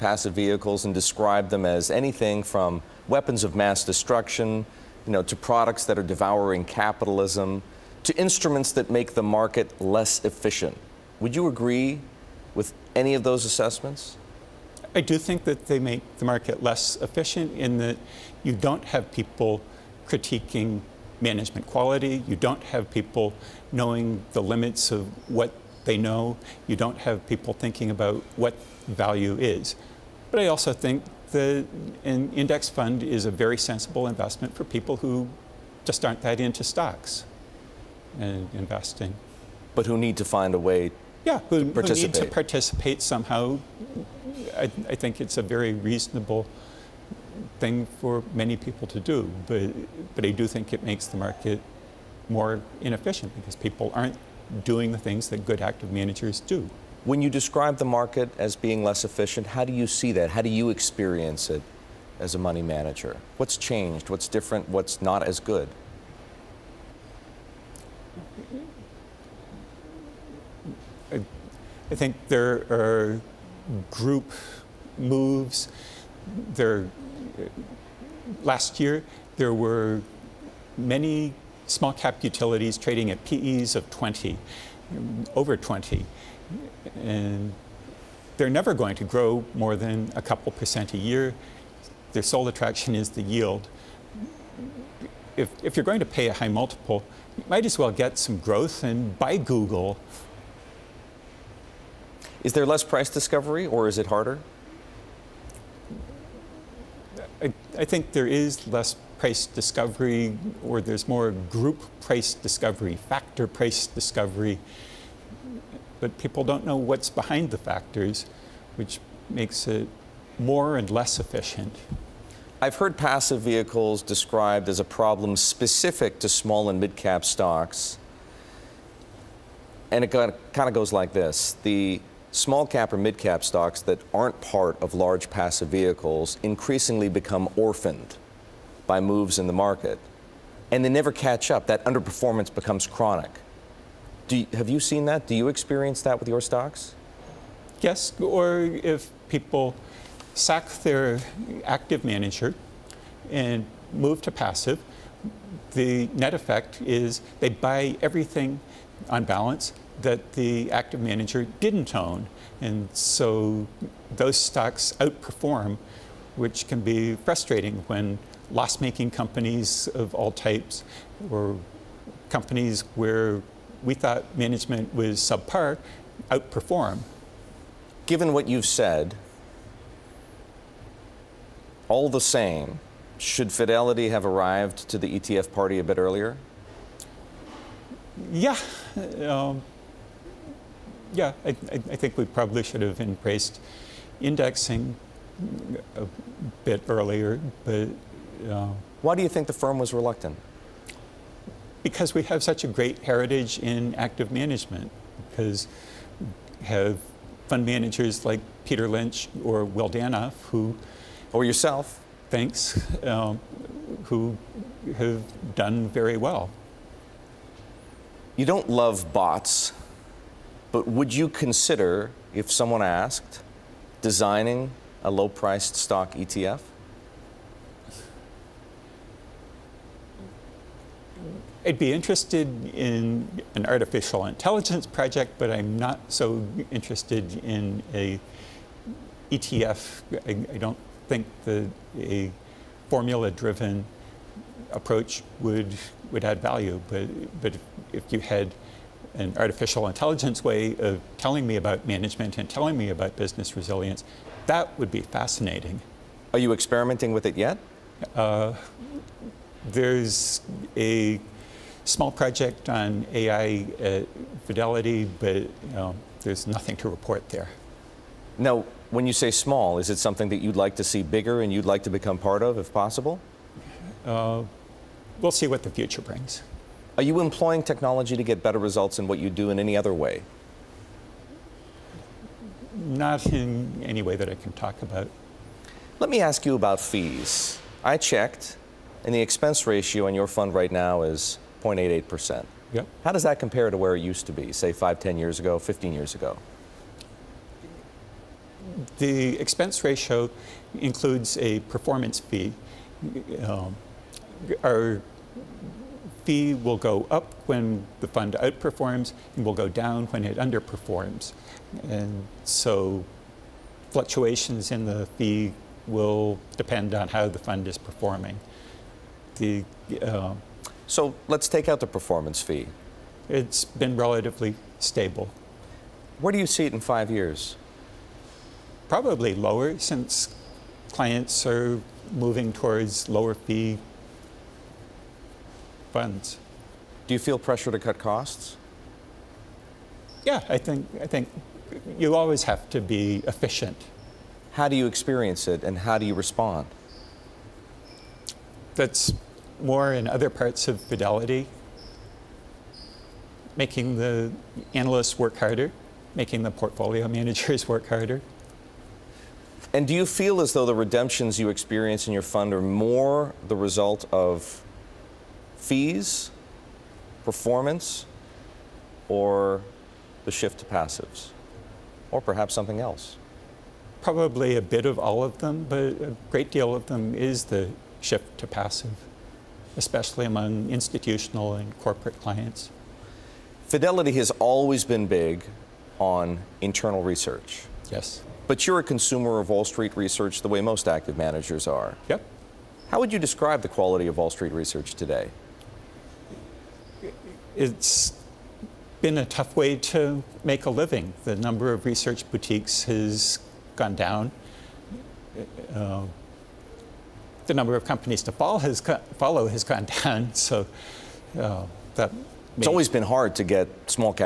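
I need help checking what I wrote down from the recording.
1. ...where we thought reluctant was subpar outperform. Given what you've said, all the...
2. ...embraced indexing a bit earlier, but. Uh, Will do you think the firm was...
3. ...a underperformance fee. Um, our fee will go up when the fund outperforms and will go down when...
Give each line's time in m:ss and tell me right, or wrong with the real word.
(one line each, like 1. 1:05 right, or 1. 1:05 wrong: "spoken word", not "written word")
1. 2:52 wrong: "management", not "reluctant"
2. 3:13 wrong: "Why", not "Will"
3. 5:01 wrong: "performance", not "underperformance".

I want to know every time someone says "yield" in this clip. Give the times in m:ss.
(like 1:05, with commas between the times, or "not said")
1:33.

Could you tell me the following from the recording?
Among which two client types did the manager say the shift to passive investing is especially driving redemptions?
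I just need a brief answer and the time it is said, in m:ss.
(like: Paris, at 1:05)
institutional and corporate, at 6:20.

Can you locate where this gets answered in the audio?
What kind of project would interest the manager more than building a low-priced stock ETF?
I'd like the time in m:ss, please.
3:53.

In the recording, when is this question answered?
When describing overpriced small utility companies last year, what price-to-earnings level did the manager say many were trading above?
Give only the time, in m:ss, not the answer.
1:25.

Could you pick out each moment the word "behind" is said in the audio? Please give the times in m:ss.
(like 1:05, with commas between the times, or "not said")
1:57.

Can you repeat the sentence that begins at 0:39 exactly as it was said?
But who need to find a way yeah, who, who need to participate somehow.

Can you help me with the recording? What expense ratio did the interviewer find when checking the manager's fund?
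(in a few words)
0.88%.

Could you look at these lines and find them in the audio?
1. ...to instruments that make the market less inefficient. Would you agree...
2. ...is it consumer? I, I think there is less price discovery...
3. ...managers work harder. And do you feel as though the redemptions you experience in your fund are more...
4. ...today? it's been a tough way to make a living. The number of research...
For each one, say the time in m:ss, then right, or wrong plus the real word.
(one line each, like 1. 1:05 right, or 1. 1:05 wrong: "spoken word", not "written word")
1. 0:08 wrong: "efficient", not "inefficient"
2. 1:43 wrong: "harder", not "consumer"
3. 5:57 right
4. 6:34 right.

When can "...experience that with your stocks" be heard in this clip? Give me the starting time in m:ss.
2:25.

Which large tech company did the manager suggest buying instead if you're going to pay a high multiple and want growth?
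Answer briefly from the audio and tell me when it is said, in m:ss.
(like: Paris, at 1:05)
Google, at 1:39.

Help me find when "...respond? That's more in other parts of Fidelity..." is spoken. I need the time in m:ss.
5:46.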